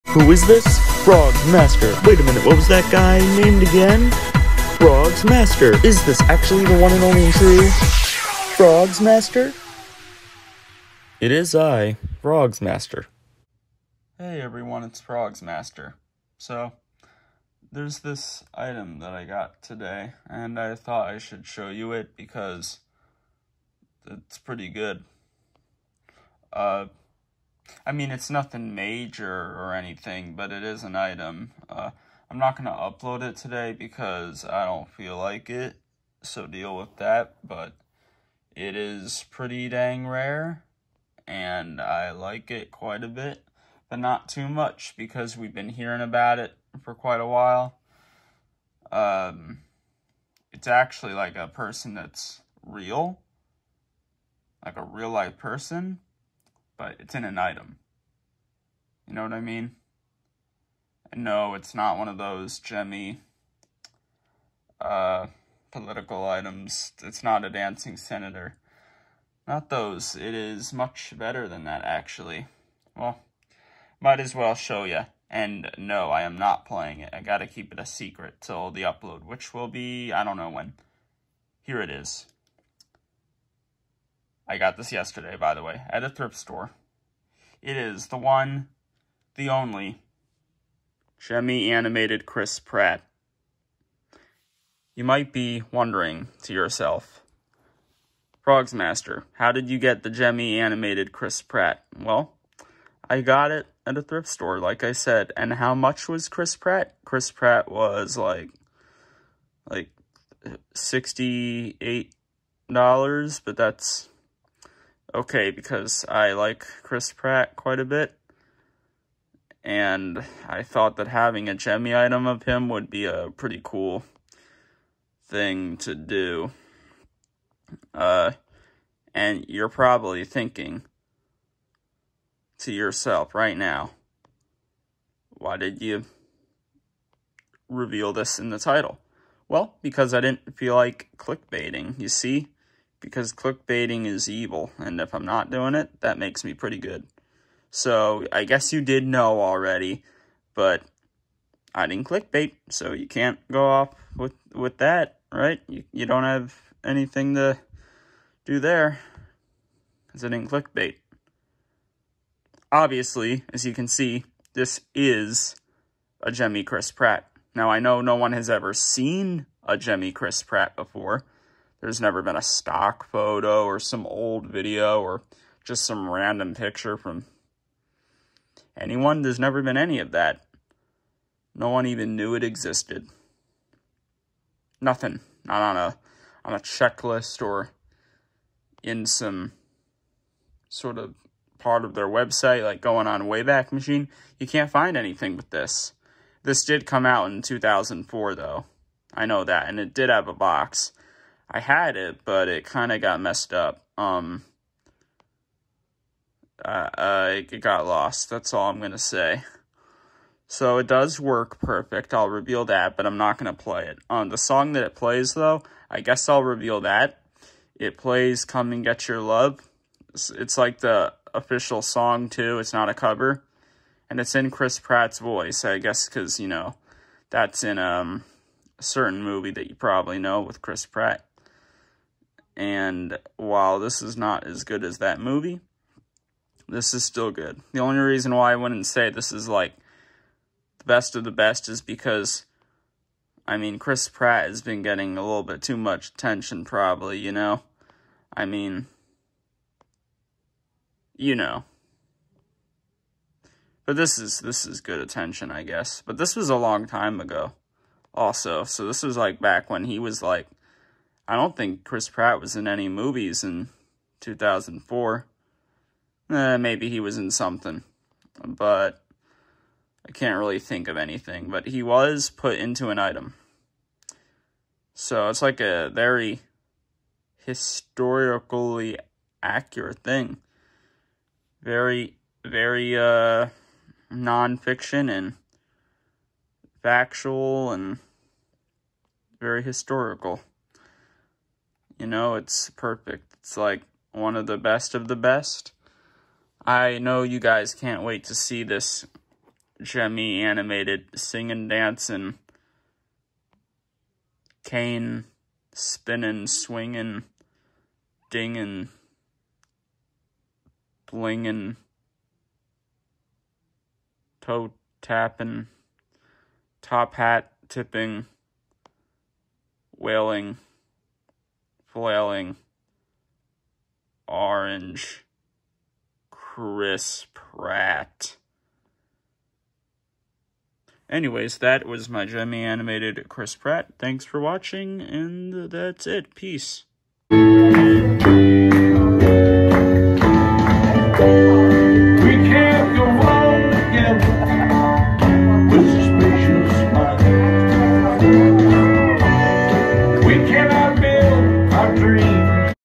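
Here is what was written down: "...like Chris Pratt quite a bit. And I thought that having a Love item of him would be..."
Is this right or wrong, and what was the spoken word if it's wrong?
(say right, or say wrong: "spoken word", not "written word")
wrong: "Gemmy", not "Love".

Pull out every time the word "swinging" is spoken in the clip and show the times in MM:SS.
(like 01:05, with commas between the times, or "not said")
05:06.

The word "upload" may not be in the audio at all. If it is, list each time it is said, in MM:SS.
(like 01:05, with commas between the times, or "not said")
00:32, 01:18.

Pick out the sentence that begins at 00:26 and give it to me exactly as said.
Uh, I mean, it's nothing major or anything, but it is an item.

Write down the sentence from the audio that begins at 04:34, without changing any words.
So it's like a very historically accurate thing.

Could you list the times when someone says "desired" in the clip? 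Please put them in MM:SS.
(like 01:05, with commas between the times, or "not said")
not said.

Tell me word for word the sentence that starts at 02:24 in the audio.
And if I'm not doing it, that makes me pretty good.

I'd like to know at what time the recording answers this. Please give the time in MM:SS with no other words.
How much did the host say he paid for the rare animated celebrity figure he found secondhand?
01:50.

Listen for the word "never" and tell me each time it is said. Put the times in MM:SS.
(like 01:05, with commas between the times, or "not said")
02:51, 02:59.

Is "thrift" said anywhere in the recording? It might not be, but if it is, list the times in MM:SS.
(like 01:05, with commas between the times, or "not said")
01:26, 01:44.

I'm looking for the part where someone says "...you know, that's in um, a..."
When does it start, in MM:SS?
03:46.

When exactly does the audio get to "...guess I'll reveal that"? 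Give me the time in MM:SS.
03:35.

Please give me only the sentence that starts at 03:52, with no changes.
And while this is not as good as that movie, this is still good.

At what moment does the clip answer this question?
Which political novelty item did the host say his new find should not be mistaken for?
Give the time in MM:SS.
01:07.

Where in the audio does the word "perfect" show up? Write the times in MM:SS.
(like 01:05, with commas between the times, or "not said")
03:31, 04:52.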